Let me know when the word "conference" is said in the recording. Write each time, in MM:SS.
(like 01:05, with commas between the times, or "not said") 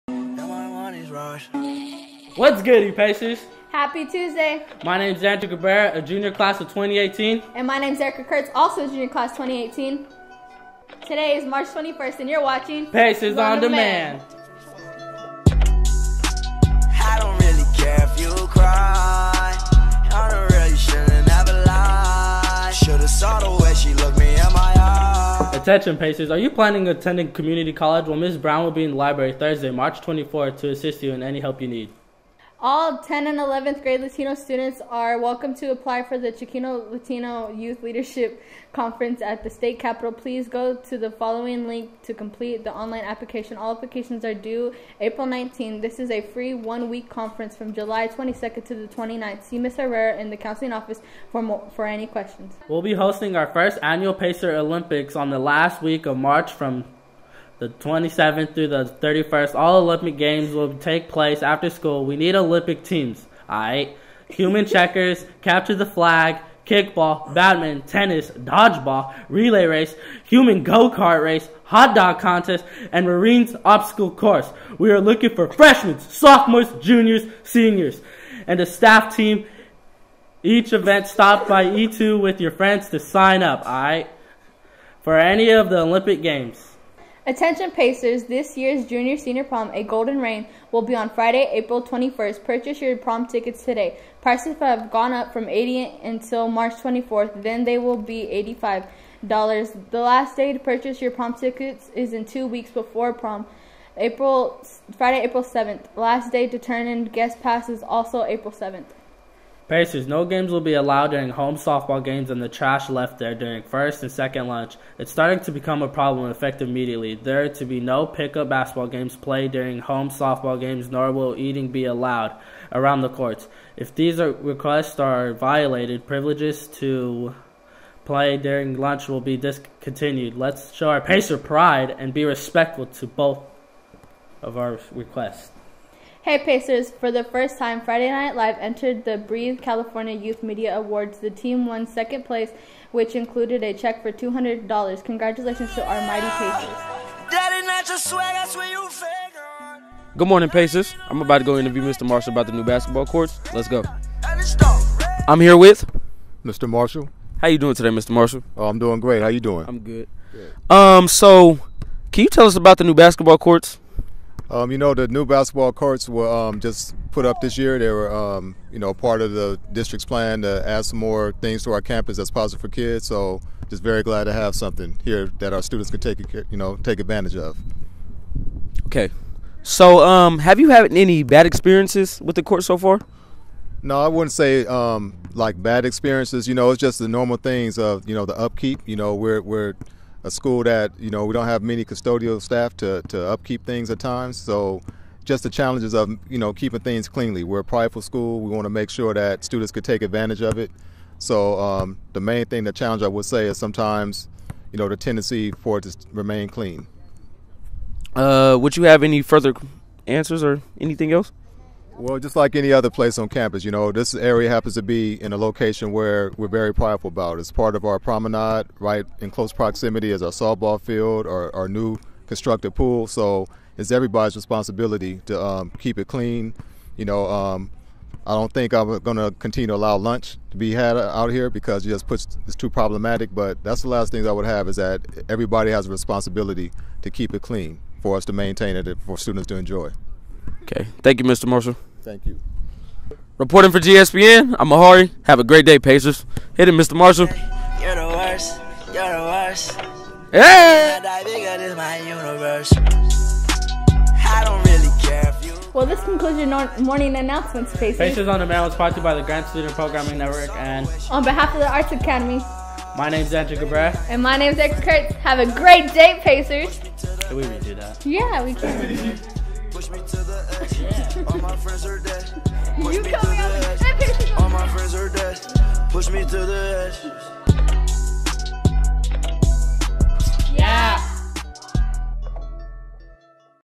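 00:38, 00:47.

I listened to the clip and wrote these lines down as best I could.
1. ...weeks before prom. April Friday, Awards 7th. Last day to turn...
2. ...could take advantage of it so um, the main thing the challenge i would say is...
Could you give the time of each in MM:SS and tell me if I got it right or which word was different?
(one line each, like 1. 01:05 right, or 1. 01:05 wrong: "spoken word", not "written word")
1. 01:42 wrong: "April", not "Awards"
2. 03:19 right.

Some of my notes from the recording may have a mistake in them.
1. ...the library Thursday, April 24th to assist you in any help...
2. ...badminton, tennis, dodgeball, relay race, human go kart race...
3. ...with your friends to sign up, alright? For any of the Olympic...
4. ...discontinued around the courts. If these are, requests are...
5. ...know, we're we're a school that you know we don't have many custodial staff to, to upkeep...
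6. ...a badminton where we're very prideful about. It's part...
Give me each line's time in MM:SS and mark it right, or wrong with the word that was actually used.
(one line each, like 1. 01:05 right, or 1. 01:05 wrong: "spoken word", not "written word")
1. 00:28 wrong: "March", not "April"
2. 01:07 right
3. 01:22 right
4. 02:01 wrong: "allowed", not "discontinued"
5. 03:08 right
6. 03:35 wrong: "location", not "badminton".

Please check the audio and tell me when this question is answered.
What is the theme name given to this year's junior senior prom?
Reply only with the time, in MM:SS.
01:29.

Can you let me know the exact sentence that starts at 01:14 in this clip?
We are looking for freshmen, sophomores, juniors, seniors, and a staff team.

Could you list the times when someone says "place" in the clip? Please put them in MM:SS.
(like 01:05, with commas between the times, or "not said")
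01:01, 02:22, 03:32.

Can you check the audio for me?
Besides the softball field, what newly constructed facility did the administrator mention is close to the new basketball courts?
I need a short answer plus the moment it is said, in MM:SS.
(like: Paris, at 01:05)
Pool, at 03:42.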